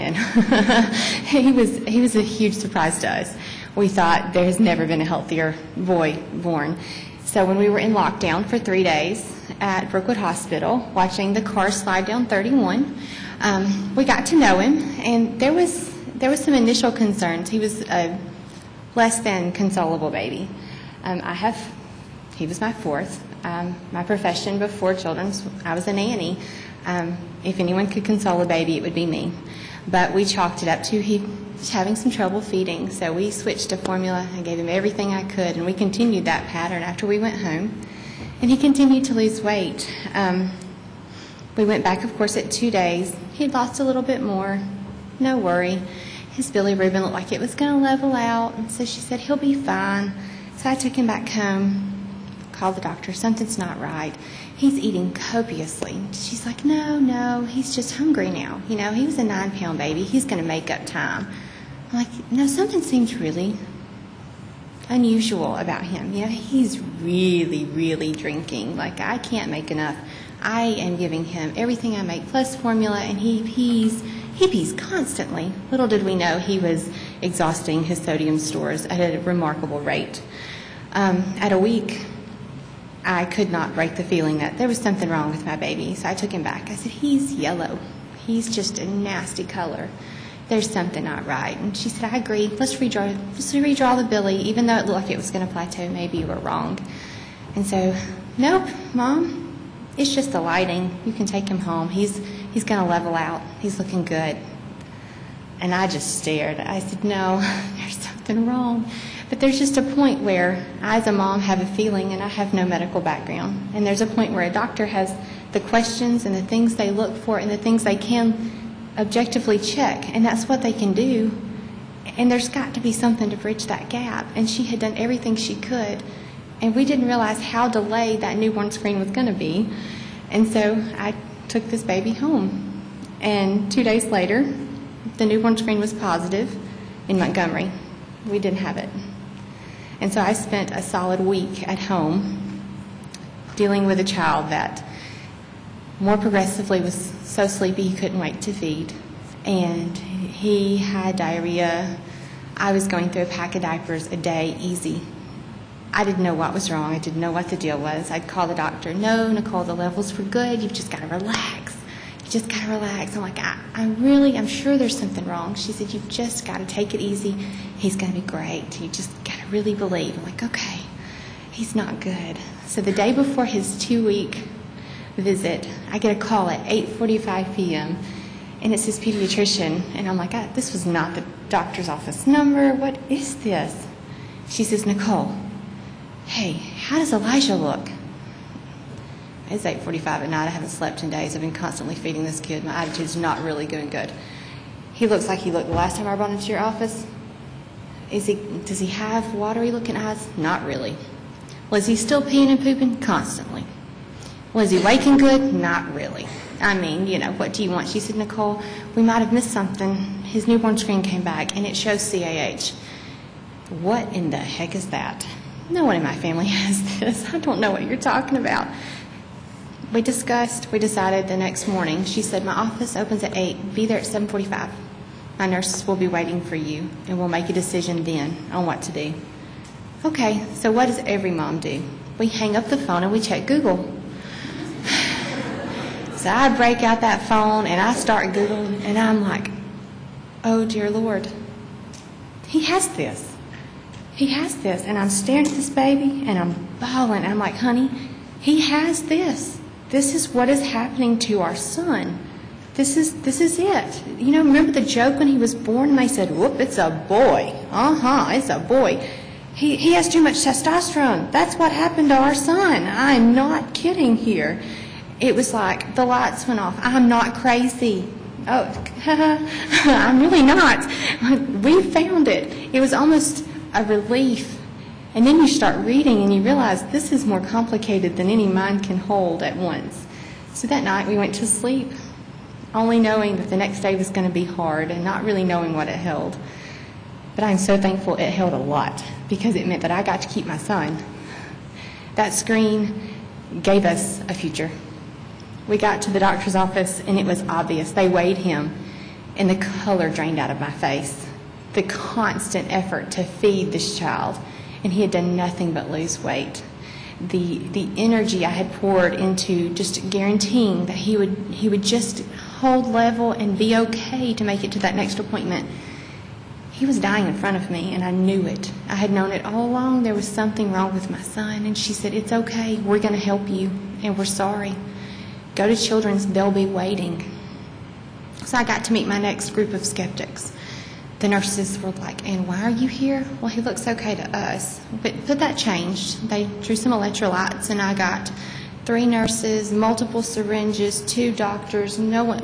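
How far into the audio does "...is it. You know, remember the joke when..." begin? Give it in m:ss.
4:13.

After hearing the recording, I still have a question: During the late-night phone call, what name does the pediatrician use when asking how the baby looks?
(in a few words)
Elijah.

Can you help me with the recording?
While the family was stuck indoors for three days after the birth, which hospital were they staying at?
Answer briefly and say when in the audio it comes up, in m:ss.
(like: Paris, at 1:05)
Brookwood Hospital, at 0:09.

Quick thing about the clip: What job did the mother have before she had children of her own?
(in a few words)
Nanny.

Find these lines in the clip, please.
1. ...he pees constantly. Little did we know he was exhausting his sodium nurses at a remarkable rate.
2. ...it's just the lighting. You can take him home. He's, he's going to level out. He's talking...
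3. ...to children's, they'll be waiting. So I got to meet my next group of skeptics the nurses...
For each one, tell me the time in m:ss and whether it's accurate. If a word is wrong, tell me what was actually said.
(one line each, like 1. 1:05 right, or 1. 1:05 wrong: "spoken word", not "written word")
1. 1:14 wrong: "stores", not "nurses"
2. 1:39 wrong: "looking", not "talking"
3. 5:25 right.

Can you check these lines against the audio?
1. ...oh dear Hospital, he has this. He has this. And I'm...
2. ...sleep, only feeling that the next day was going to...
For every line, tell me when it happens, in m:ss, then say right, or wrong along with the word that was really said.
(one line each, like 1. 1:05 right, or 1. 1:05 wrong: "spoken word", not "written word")
1. 4:00 wrong: "Lord", not "Hospital"
2. 4:41 wrong: "knowing", not "feeling".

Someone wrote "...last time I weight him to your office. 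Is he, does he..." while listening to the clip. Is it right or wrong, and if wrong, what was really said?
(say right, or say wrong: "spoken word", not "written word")
wrong: "brought", not "weight".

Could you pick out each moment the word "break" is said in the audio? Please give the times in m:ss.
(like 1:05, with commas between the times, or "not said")
1:23, 3:56.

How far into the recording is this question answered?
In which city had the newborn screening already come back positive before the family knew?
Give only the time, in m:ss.
2:17.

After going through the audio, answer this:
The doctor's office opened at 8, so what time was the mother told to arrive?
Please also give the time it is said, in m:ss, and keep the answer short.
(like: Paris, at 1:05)
7:45, at 3:44.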